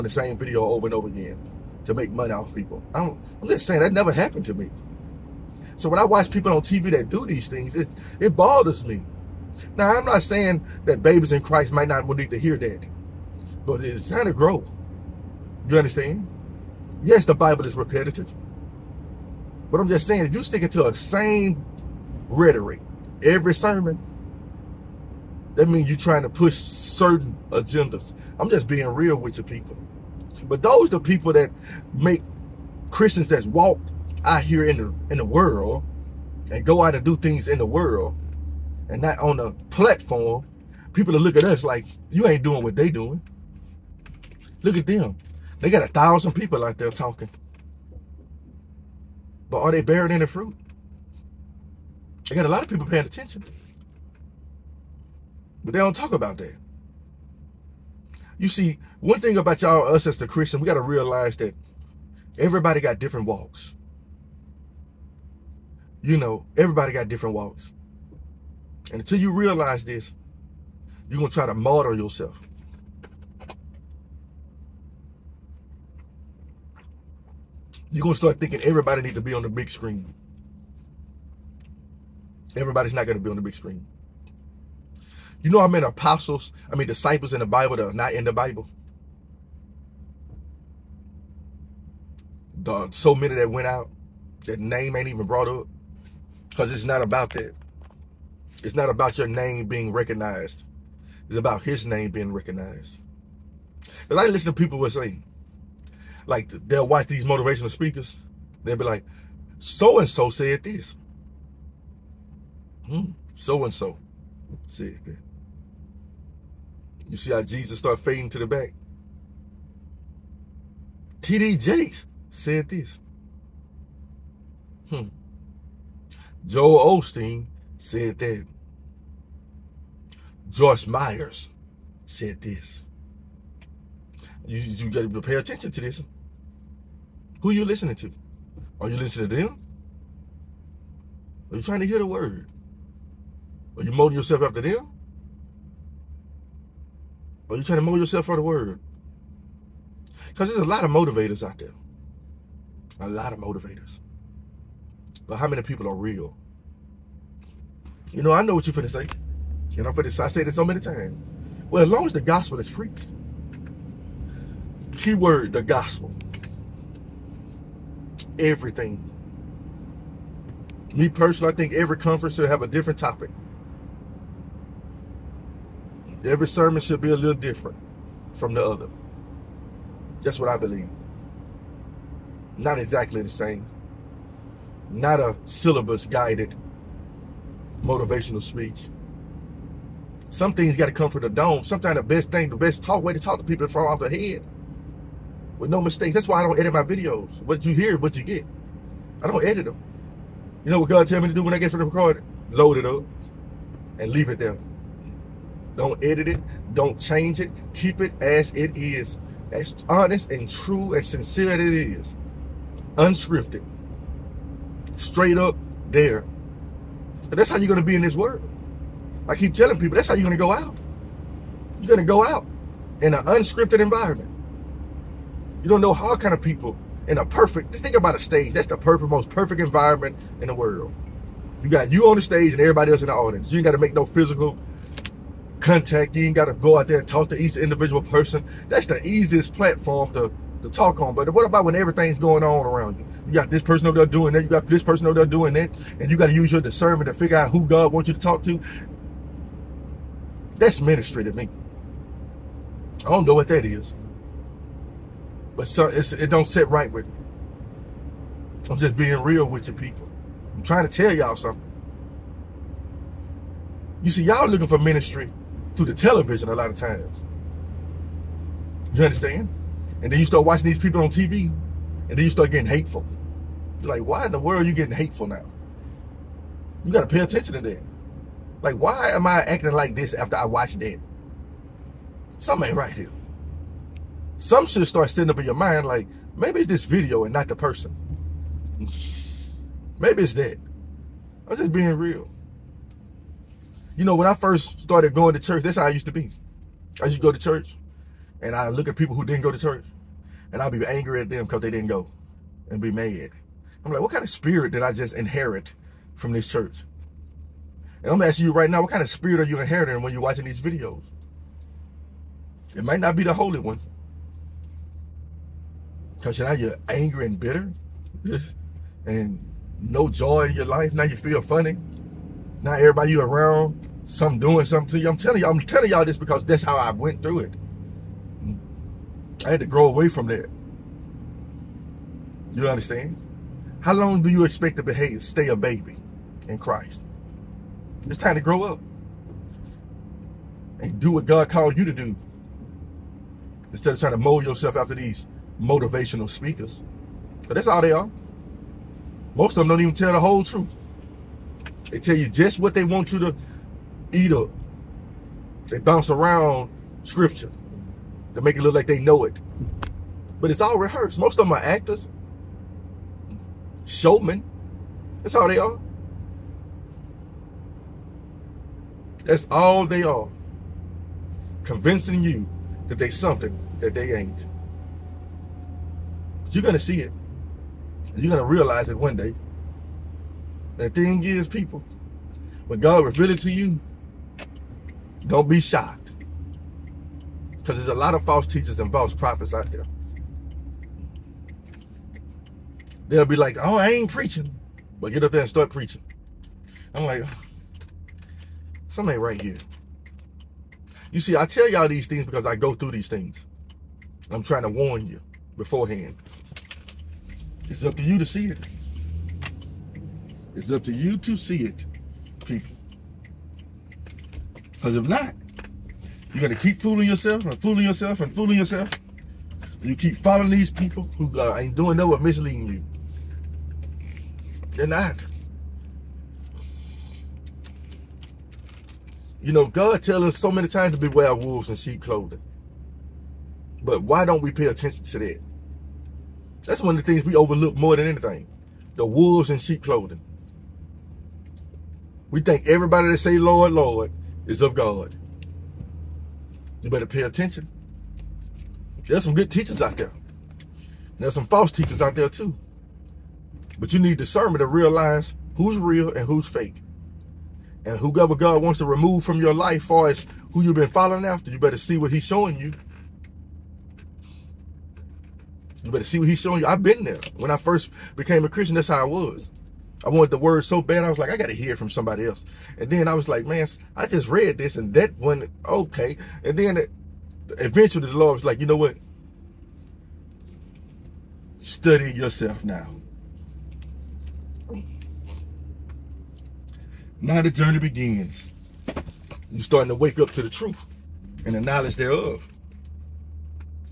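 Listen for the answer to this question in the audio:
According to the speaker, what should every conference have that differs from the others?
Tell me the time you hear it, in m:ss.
2:52.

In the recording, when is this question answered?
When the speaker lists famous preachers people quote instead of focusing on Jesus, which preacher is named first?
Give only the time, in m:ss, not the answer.
2:01.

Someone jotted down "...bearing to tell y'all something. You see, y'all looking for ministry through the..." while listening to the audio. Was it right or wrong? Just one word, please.
wrong.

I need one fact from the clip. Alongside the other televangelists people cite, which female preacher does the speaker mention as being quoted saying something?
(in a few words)
Joyce Myers.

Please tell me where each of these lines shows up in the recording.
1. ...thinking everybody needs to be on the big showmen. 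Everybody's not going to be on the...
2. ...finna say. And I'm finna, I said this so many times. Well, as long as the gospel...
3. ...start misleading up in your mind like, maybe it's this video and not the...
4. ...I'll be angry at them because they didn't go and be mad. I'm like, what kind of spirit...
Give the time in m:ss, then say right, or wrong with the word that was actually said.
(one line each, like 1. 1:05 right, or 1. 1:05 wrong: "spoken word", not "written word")
1. 1:18 wrong: "screen", not "showmen"
2. 2:38 right
3. 4:44 wrong: "sitting", not "misleading"
4. 5:00 right.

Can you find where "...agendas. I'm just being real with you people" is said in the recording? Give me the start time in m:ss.
0:27.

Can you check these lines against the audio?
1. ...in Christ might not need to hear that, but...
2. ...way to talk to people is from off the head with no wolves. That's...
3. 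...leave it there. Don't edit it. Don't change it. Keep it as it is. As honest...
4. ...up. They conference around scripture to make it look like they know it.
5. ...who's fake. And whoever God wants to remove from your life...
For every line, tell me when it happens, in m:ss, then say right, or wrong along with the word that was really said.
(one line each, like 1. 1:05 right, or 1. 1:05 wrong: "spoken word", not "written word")
1. 0:11 right
2. 3:13 wrong: "mistakes", not "wolves"
3. 3:24 right
4. 5:54 wrong: "bounce", not "conference"
5. 7:36 right.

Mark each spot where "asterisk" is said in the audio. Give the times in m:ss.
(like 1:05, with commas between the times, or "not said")
not said.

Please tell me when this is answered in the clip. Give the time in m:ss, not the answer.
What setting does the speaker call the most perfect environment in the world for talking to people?
3:48.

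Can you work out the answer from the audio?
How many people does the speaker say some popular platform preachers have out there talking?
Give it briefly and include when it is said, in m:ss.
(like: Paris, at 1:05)
1000, at 0:45.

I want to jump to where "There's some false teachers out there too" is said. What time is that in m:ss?
7:31.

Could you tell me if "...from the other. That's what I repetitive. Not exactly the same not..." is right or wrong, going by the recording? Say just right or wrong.
wrong.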